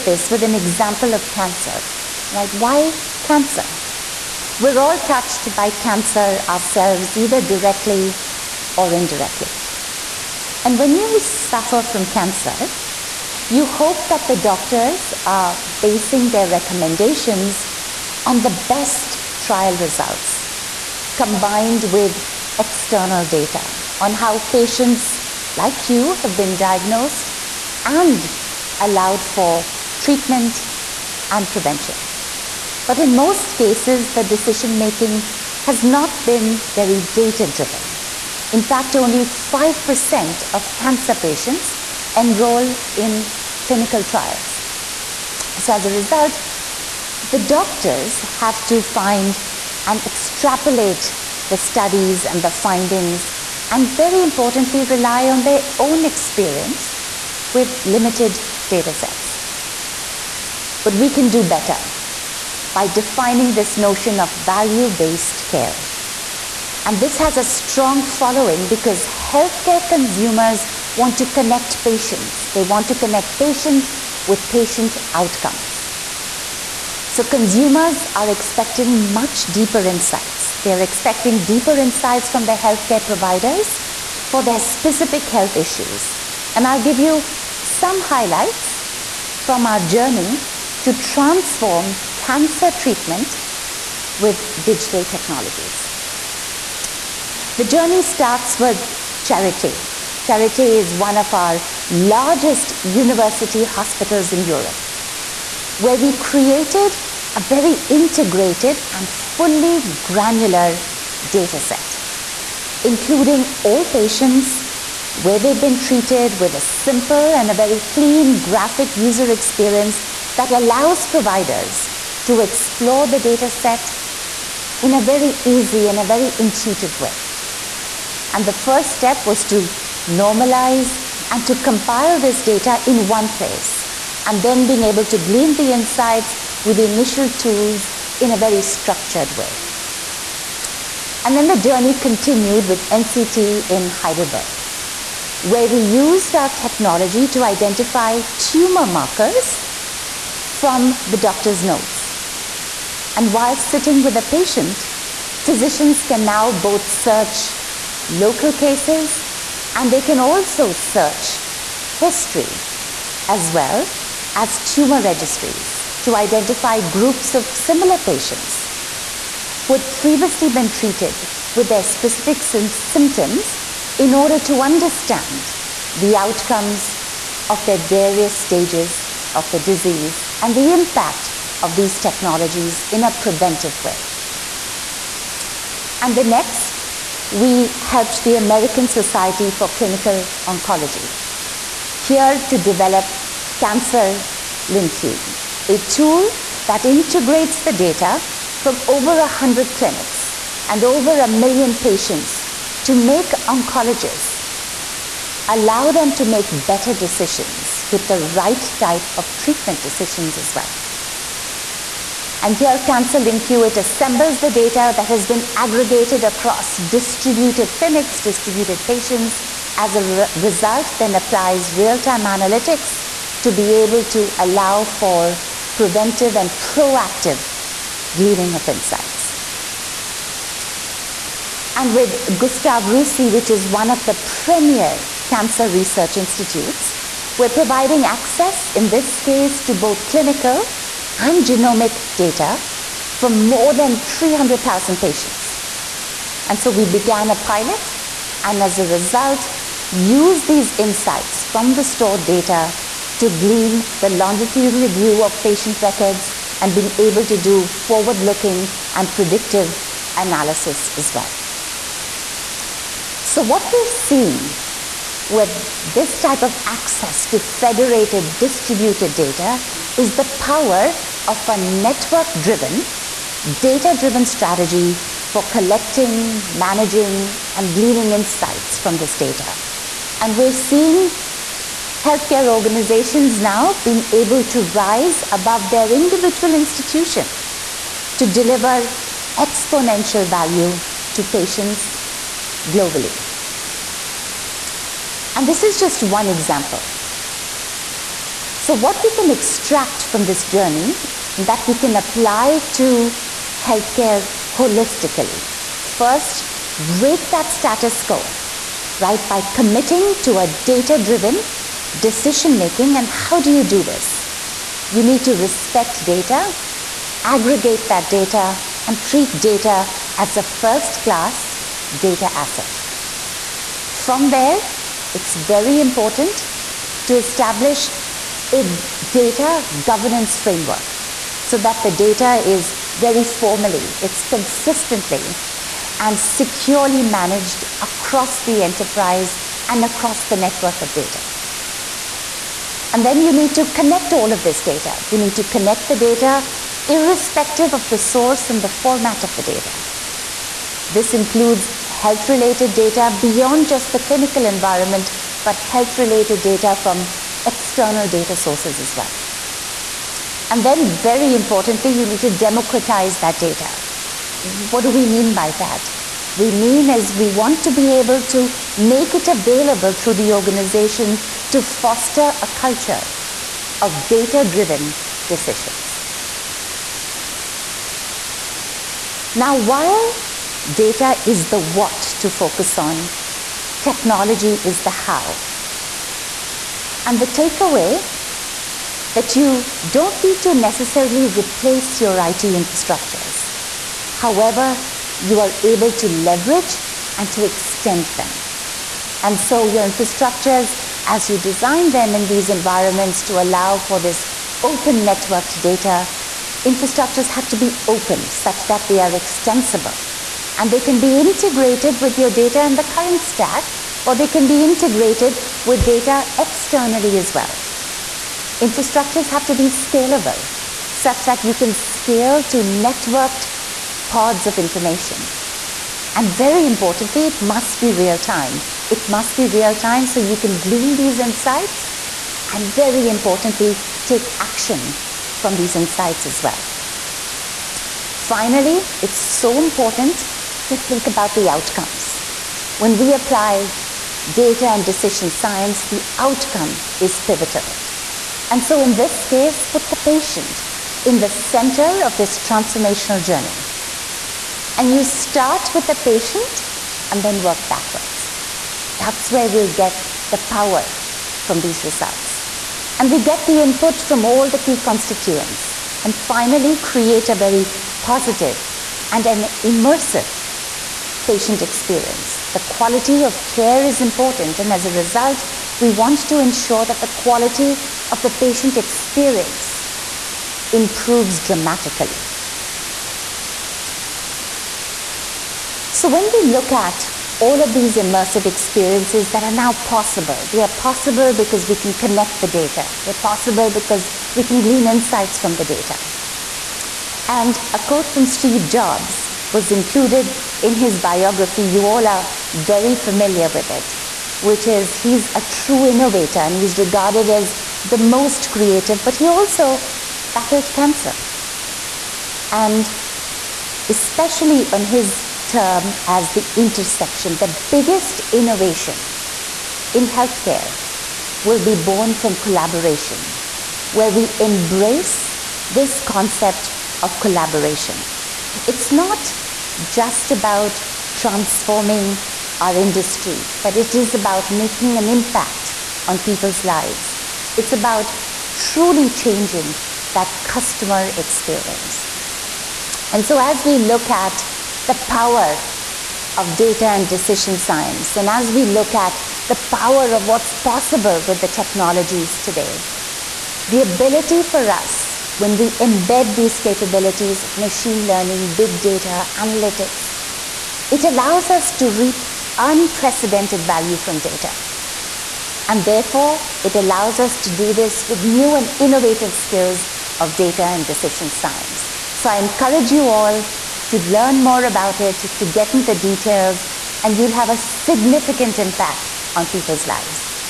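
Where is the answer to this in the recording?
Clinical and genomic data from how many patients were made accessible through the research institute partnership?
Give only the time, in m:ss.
4:03.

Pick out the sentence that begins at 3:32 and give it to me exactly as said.
And here, Cancer LinQ, it assembles the data that has been aggregated across distributed clinics, distributed patients.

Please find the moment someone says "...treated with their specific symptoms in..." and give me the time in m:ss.
2:50.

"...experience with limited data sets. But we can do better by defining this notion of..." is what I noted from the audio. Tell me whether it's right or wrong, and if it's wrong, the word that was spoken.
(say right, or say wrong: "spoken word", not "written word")
right.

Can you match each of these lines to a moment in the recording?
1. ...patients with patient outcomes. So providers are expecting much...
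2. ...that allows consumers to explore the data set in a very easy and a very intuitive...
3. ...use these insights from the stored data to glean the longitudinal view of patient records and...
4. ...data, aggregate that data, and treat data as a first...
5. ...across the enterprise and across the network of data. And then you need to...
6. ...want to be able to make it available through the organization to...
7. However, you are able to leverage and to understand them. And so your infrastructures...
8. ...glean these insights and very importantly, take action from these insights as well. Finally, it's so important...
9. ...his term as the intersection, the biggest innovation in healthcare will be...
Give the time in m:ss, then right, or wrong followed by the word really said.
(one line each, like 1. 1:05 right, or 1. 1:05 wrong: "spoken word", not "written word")
1. 1:13 wrong: "consumers", not "providers"
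2. 2:00 wrong: "providers", not "consumers"
3. 4:09 right
4. 5:16 right
5. 5:37 right
6. 6:07 right
7. 6:34 wrong: "extend", not "understand"
8. 7:10 right
9. 8:34 right.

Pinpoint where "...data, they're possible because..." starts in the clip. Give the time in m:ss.
8:12.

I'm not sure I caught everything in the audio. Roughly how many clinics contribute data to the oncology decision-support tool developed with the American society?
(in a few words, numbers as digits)
over 100.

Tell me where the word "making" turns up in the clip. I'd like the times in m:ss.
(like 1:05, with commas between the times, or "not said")
0:34, 5:12, 8:54.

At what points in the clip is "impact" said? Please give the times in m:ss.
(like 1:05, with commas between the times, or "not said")
3:00, 8:55, 9:38.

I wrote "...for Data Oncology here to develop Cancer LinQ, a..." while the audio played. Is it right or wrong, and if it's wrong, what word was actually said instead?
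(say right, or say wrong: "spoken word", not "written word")
wrong: "Clinical", not "Data".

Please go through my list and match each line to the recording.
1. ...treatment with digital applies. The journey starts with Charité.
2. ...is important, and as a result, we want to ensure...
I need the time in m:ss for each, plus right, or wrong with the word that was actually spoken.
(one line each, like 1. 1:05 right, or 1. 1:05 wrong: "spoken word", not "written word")
1. 1:32 wrong: "technologies", not "applies"
2. 7:53 right.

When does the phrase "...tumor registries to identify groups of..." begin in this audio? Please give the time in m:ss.
2:44.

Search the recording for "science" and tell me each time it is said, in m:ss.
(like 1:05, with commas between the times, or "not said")
7:25, 9:07, 9:31.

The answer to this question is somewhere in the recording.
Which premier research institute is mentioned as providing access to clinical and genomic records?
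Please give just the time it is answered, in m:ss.
3:52.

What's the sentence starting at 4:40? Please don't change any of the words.
And we're seeing healthcare organizations now being able to rise above their individual institution to deliver exponential value to patients globally.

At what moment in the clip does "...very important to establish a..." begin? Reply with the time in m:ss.
5:25.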